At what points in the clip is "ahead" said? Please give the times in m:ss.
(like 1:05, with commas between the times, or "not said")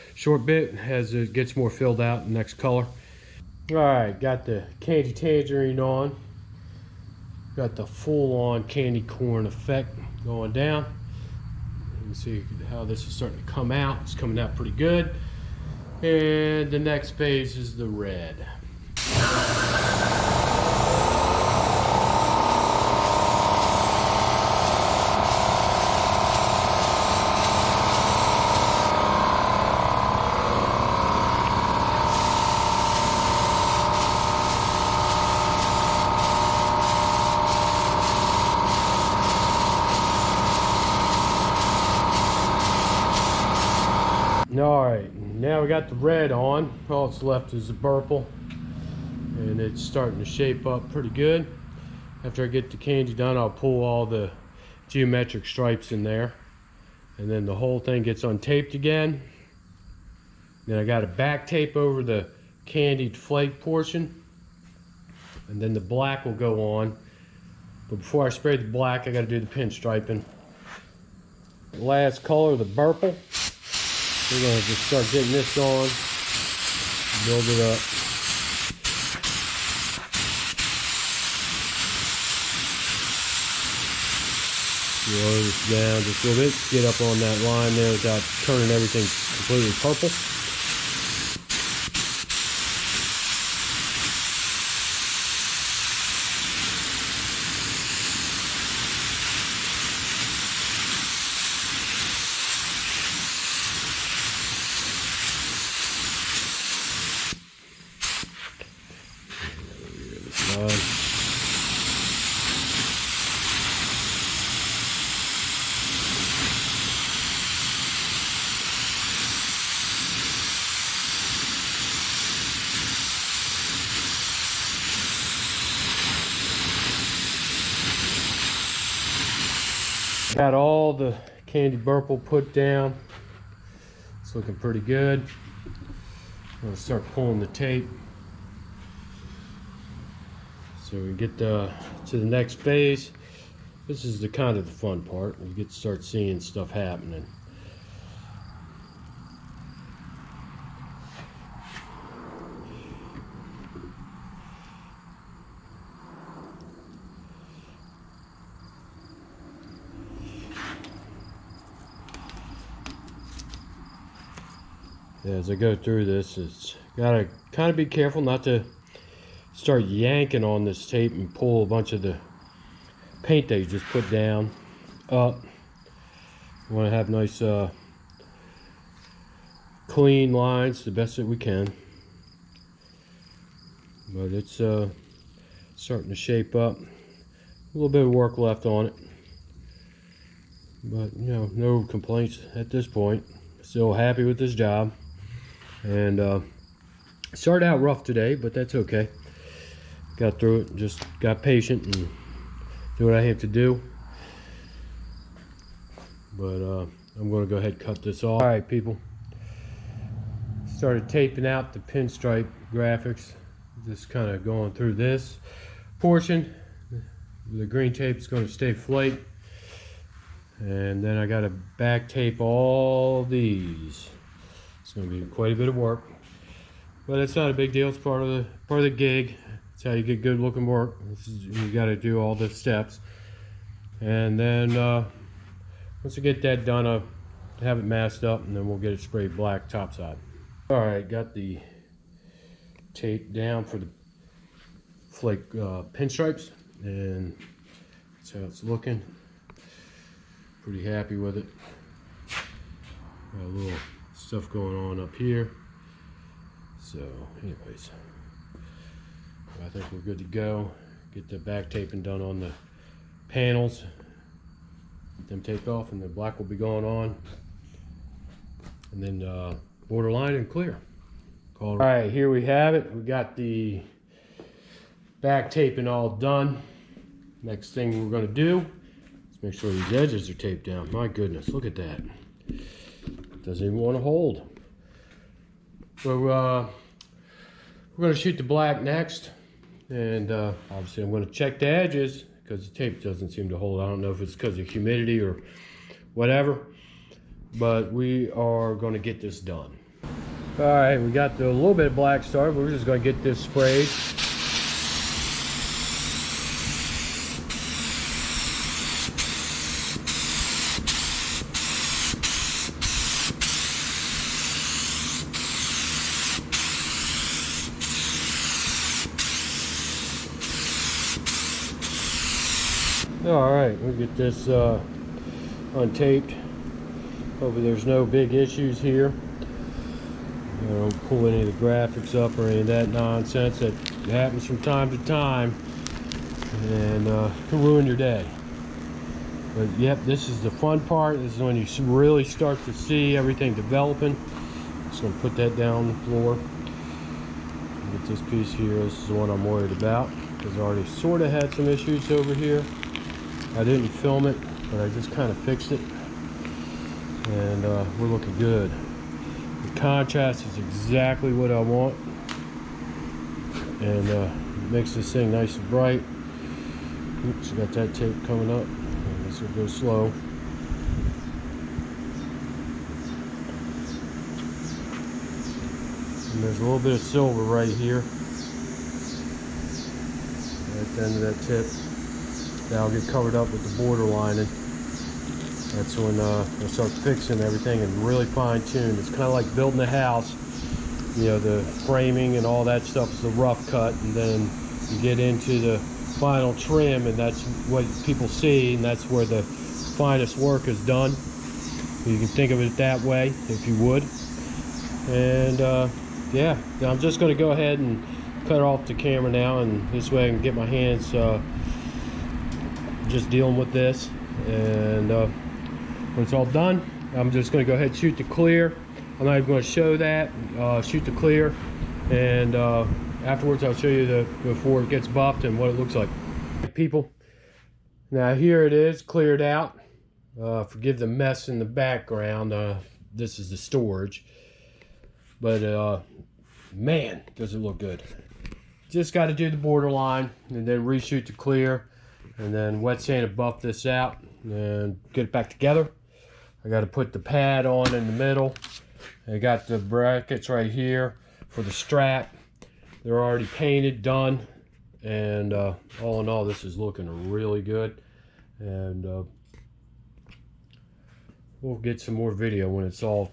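3:27, 6:47, 6:57.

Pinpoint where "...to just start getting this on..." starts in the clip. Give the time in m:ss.
1:14.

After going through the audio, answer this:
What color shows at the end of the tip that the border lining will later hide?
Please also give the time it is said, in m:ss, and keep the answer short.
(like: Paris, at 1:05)
Silver, at 6:16.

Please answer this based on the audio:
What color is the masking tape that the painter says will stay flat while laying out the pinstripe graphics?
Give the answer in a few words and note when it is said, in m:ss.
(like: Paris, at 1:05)
Green, at 3:37.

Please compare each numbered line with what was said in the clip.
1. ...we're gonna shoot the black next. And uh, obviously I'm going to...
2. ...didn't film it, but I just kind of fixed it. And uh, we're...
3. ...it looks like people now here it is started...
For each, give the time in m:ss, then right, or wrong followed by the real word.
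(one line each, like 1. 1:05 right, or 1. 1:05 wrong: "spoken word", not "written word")
1. 4:47 right
2. 5:53 right
3. 7:05 wrong: "cleared", not "started".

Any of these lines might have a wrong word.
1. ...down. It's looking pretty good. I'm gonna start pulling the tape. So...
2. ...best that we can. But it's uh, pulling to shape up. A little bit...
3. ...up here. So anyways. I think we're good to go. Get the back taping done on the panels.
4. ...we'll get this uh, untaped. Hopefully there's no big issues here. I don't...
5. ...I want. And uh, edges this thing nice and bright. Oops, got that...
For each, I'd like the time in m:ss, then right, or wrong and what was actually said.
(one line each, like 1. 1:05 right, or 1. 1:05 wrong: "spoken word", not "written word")
1. 2:12 right
2. 3:00 wrong: "starting", not "pulling"
3. 4:14 right
4. 5:23 right
5. 6:01 wrong: "makes", not "edges".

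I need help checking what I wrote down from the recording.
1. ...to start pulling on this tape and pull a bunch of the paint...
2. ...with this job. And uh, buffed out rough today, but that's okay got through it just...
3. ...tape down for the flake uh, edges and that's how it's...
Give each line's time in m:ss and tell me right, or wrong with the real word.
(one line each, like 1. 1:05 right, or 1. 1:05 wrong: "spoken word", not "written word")
1. 2:48 wrong: "yanking", not "pulling"
2. 3:14 wrong: "started", not "buffed"
3. 4:02 wrong: "pinstripes", not "edges".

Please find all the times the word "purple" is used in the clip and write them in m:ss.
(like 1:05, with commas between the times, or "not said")
0:47, 1:12, 1:29.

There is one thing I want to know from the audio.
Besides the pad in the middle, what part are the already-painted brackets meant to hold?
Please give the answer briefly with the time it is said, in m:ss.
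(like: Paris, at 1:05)
The strap, at 7:31.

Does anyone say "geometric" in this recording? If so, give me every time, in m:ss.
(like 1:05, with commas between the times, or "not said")
0:54.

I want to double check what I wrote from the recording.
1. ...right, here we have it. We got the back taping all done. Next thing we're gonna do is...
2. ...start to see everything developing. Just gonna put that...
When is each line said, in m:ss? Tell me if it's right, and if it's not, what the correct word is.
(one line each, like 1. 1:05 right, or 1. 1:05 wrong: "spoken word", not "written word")
1. 4:31 right
2. 5:42 right.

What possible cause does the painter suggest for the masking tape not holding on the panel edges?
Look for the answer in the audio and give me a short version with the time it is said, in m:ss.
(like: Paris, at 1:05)
Humidity, at 4:54.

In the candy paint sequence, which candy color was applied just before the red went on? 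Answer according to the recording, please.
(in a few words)
Tangerine.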